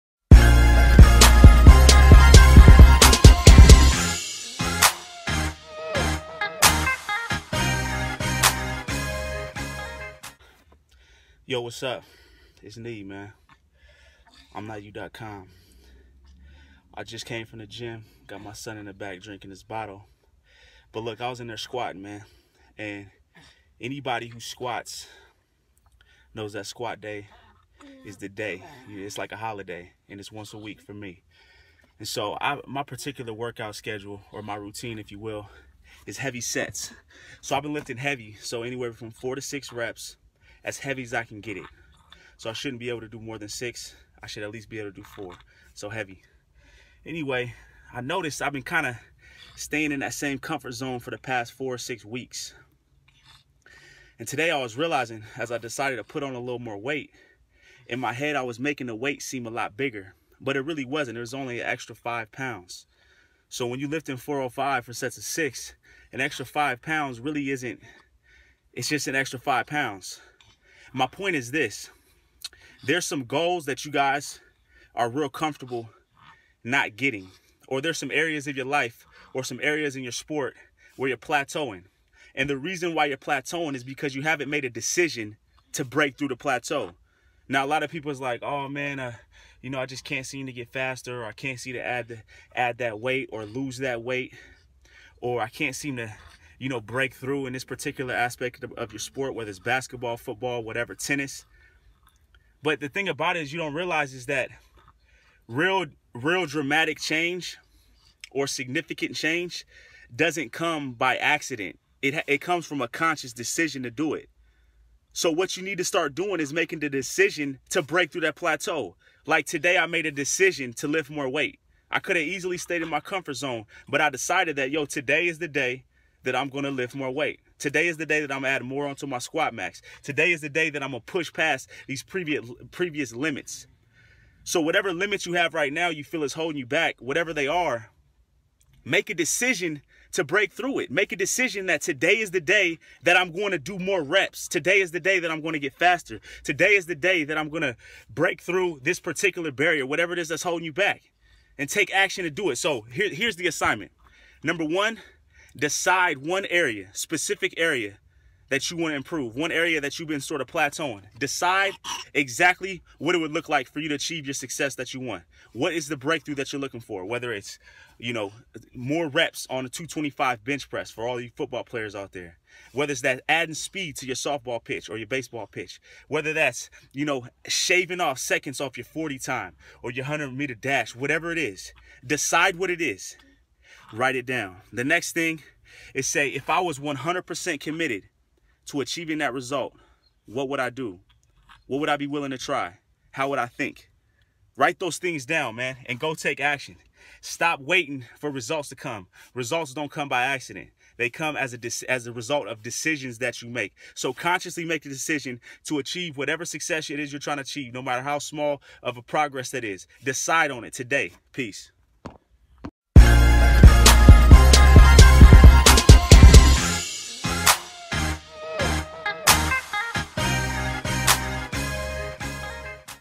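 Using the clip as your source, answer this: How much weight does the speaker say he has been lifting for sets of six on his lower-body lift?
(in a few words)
405.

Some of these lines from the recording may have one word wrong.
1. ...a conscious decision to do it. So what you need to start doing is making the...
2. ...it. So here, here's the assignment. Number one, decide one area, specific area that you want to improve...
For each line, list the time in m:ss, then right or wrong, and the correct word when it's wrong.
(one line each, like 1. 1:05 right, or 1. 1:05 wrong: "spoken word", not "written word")
1. 1:52 right
2. 2:32 right.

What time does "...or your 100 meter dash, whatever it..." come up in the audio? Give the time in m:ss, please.
2:59.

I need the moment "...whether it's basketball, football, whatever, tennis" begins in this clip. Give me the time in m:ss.
1:39.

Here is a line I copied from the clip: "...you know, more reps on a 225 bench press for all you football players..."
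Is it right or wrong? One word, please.
right.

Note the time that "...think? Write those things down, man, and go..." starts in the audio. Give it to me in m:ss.
3:13.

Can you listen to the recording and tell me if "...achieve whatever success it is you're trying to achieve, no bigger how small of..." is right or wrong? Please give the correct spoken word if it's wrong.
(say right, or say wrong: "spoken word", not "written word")
wrong: "matter", not "bigger".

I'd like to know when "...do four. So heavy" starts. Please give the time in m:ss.
0:44.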